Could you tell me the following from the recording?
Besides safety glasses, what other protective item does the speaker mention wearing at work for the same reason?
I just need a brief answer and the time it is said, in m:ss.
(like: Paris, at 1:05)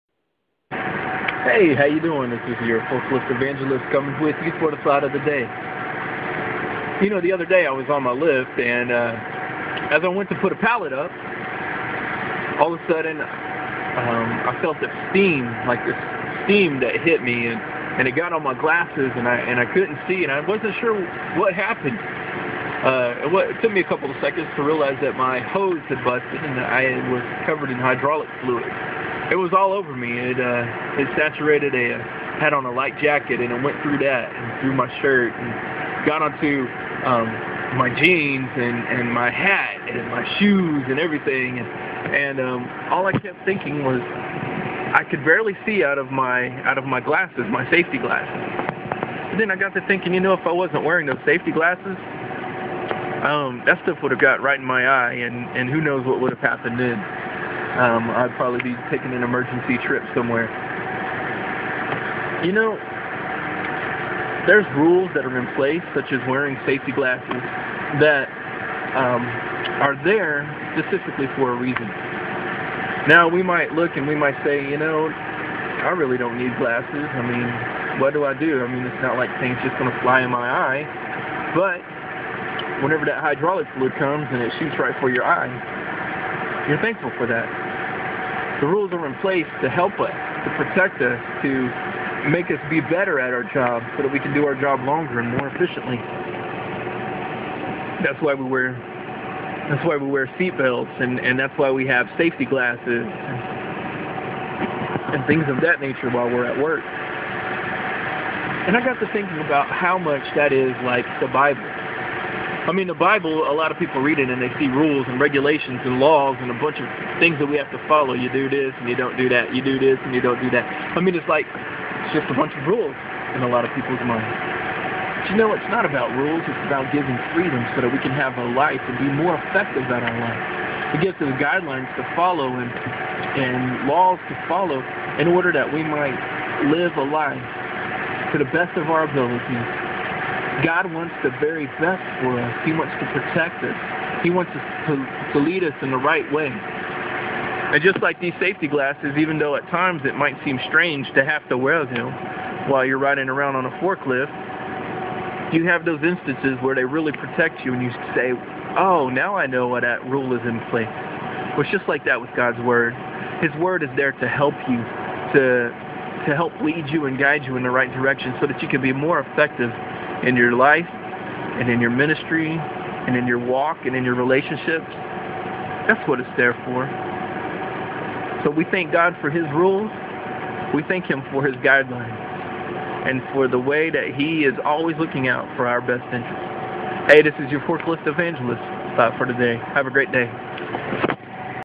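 seatbelts, at 1:40.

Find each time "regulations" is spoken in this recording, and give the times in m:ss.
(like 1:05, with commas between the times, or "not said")
1:55.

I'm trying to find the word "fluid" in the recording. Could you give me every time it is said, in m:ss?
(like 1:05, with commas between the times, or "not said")
0:28, 1:23.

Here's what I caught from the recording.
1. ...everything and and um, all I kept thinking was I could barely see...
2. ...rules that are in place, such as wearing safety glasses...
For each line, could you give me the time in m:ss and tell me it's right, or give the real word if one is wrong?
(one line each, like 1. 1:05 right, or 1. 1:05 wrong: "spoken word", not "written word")
1. 0:40 right
2. 1:04 right.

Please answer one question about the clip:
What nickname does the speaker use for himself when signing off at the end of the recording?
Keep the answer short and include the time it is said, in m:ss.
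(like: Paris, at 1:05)
forklift evangelist, at 3:07.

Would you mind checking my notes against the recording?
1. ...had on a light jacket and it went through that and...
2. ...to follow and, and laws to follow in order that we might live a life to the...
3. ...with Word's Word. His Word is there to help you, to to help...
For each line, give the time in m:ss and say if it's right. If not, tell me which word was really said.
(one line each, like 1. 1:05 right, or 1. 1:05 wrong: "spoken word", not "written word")
1. 0:32 right
2. 2:11 right
3. 2:42 wrong: "God", not "Word".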